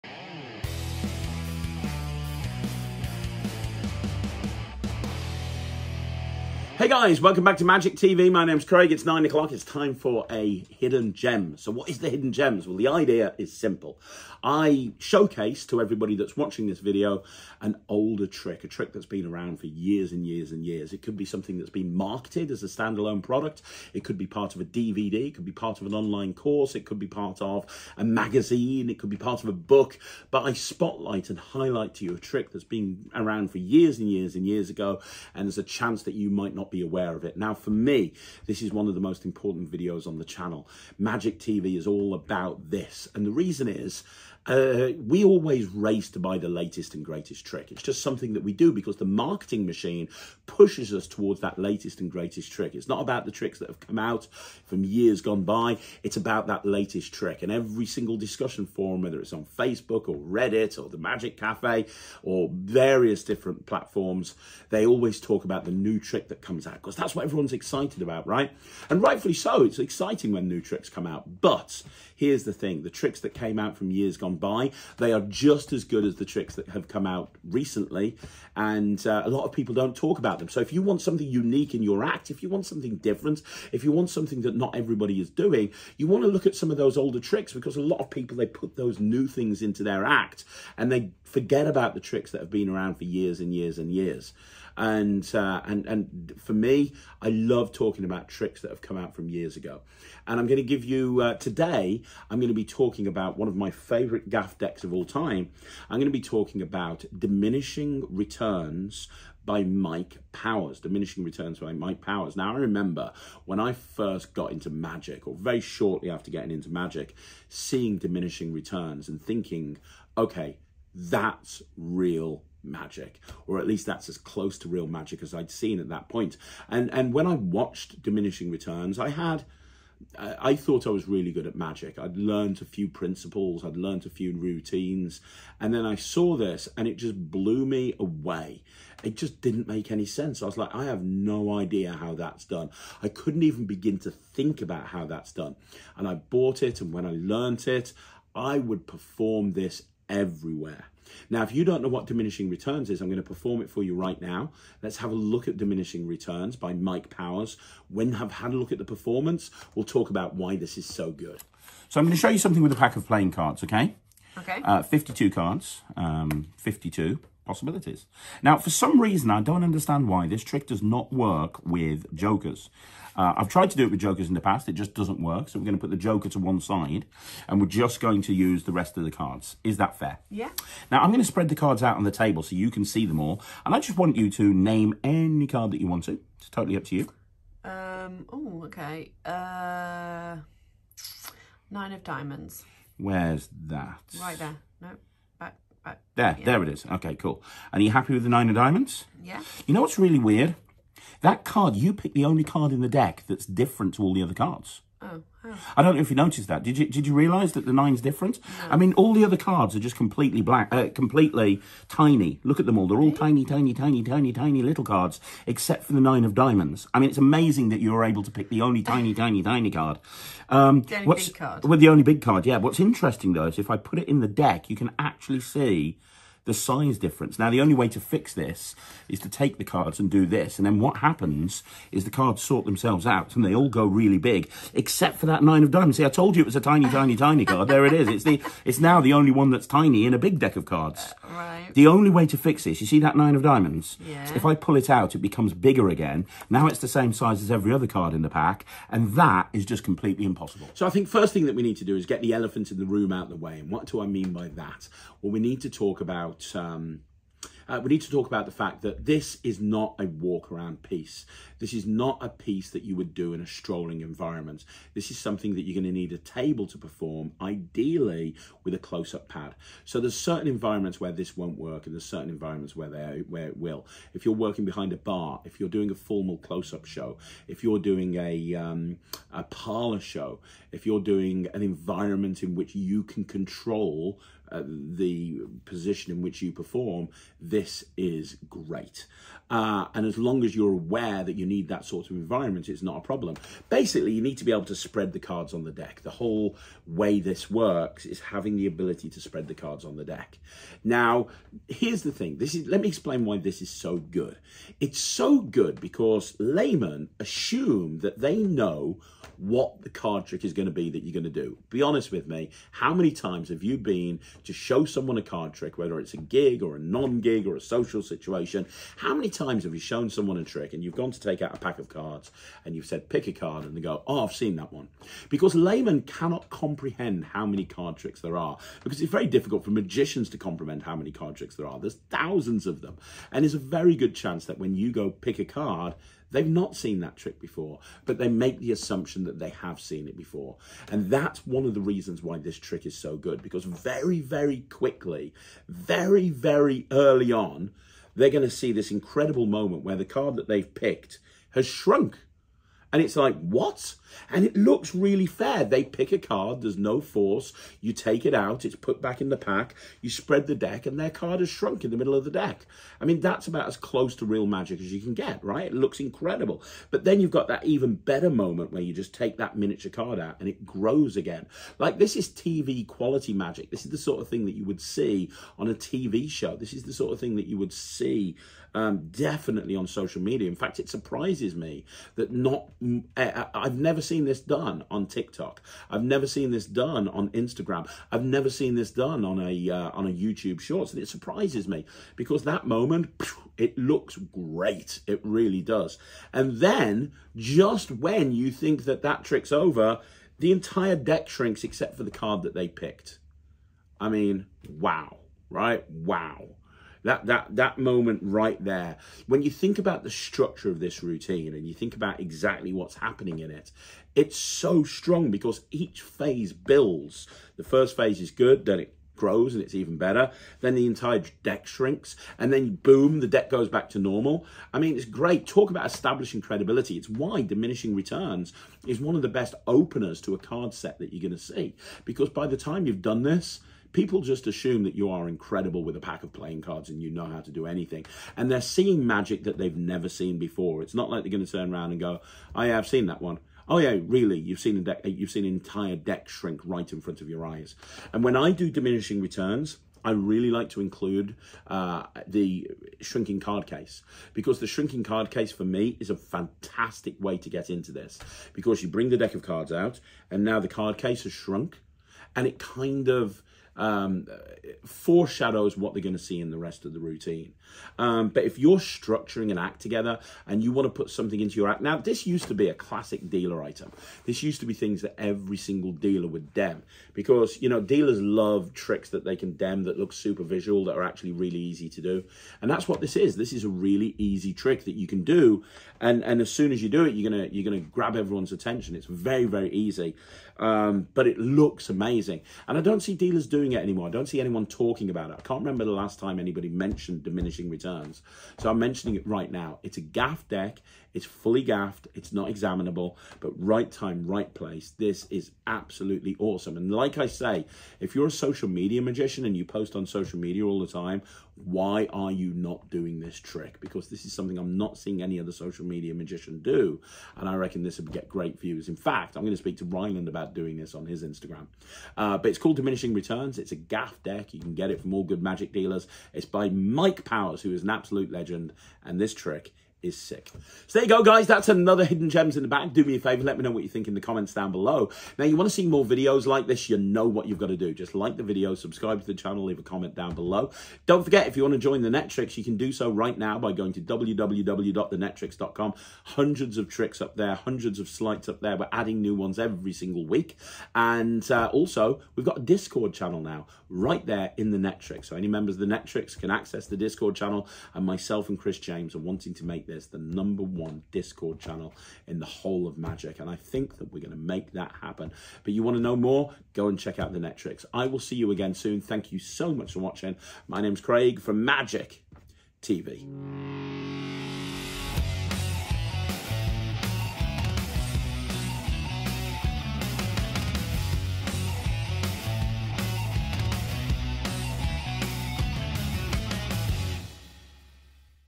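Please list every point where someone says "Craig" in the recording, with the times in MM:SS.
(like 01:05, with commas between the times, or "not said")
00:08, 09:31.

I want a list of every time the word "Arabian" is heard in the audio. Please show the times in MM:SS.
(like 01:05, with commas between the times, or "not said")
not said.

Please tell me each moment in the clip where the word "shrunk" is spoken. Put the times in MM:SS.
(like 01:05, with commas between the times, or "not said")
05:51, 06:01, 07:41.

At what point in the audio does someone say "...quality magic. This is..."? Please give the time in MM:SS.
06:12.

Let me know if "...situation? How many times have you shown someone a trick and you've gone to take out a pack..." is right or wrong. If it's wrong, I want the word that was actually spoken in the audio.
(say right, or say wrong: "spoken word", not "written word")
right.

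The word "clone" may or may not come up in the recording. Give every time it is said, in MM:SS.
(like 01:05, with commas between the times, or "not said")
not said.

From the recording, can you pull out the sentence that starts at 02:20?
I was like, I have no idea how that's done.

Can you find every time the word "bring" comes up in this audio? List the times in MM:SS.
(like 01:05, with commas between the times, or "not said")
07:38.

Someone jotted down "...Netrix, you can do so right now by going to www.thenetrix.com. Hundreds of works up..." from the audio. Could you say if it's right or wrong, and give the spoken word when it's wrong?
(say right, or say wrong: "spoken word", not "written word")
wrong: "tricks", not "works".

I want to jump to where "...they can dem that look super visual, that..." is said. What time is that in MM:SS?
07:59.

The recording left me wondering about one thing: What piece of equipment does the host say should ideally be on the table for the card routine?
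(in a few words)
A close up pad.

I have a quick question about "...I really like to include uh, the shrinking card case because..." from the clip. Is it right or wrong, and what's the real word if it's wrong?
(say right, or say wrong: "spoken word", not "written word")
right.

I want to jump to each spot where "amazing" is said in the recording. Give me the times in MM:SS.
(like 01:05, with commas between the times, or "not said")
03:37, 08:11.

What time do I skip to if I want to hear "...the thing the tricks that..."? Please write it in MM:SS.
01:12.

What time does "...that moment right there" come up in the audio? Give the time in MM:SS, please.
06:47.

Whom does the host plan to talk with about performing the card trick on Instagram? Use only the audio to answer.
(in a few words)
Ryland.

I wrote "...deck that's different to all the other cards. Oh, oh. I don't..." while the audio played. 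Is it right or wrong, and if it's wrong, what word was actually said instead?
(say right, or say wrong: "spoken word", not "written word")
right.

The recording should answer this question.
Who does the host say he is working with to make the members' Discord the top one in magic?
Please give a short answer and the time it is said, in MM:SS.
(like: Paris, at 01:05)
Chris James, at 09:18.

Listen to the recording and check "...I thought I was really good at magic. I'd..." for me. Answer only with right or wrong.
right.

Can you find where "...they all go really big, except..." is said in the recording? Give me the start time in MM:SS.
03:53.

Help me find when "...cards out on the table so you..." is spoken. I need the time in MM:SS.
03:01.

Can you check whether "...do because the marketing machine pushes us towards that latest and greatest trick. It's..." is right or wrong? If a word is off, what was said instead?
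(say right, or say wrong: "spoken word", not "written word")
right.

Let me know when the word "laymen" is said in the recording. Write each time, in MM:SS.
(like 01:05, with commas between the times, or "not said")
05:06, 05:25.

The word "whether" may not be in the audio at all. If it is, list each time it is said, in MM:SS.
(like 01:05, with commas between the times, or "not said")
00:59, 05:15.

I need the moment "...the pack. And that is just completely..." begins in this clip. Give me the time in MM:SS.
04:08.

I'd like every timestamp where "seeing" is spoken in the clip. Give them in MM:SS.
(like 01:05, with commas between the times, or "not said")
01:57, 07:18, 08:34.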